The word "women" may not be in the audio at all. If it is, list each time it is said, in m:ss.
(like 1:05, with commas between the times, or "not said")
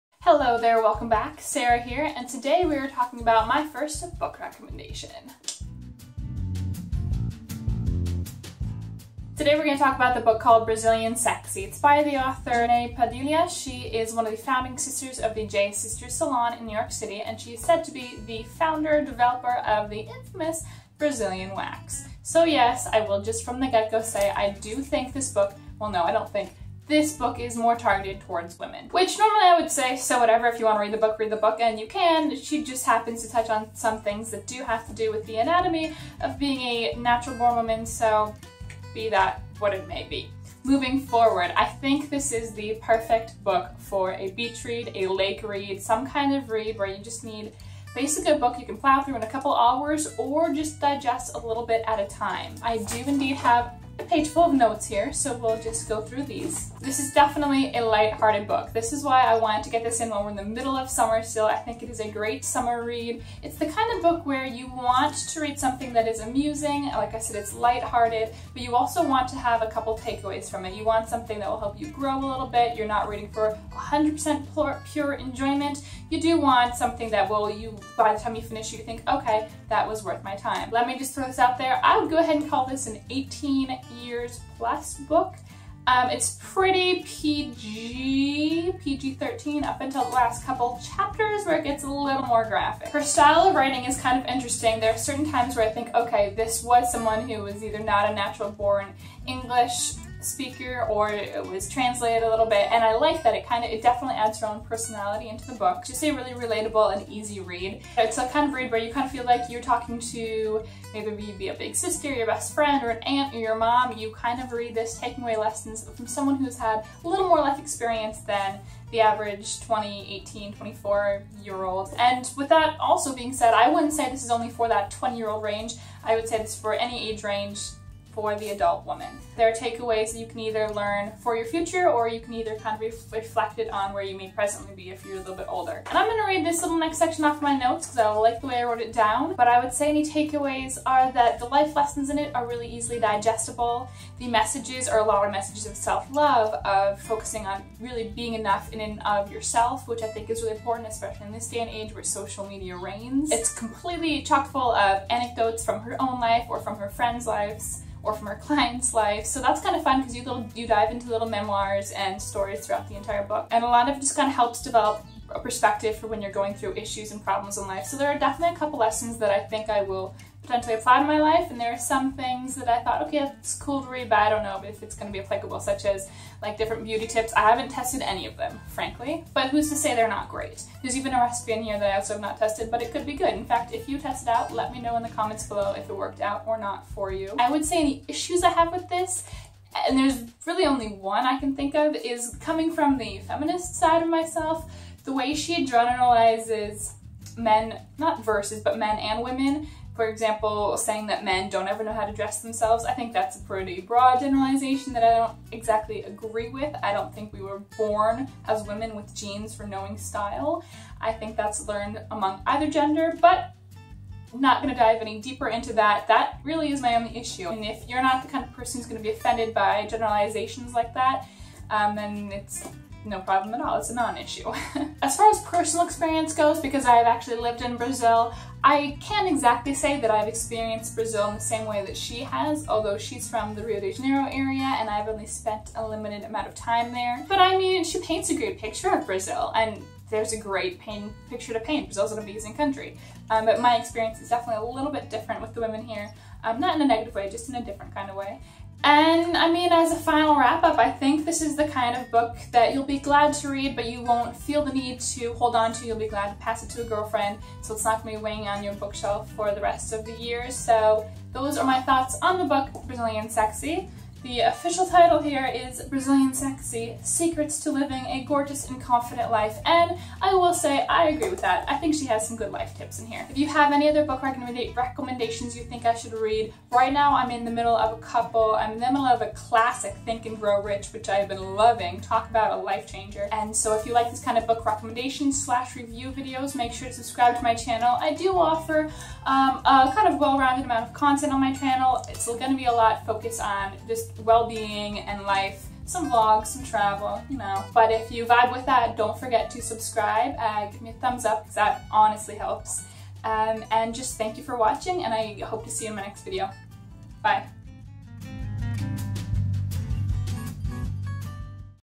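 0:28, 3:19, 3:28, 4:05.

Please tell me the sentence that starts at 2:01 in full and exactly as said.
And with that also being said, I wouldn't say this is only for that 20 year old range.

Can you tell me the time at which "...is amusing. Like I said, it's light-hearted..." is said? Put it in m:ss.
1:06.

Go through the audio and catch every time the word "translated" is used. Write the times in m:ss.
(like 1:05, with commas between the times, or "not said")
1:41.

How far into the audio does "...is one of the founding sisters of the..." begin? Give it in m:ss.
0:13.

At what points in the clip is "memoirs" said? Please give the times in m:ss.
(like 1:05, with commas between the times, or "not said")
2:41.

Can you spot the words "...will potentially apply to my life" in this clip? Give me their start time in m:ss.
2:49.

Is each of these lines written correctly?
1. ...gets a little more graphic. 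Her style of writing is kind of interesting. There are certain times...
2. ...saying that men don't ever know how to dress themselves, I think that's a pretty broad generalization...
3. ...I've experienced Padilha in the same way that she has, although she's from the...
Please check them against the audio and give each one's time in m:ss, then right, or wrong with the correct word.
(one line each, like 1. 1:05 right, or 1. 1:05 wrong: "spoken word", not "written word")
1. 1:31 right
2. 3:20 right
3. 3:50 wrong: "Brazil", not "Padilha".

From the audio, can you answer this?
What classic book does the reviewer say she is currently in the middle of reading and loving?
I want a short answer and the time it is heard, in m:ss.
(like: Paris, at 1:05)
Think and Grow Rich, at 4:40.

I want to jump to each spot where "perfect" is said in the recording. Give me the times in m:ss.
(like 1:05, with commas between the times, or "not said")
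0:42.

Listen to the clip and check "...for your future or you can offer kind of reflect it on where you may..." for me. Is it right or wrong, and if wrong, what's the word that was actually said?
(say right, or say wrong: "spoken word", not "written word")
wrong: "either", not "offer".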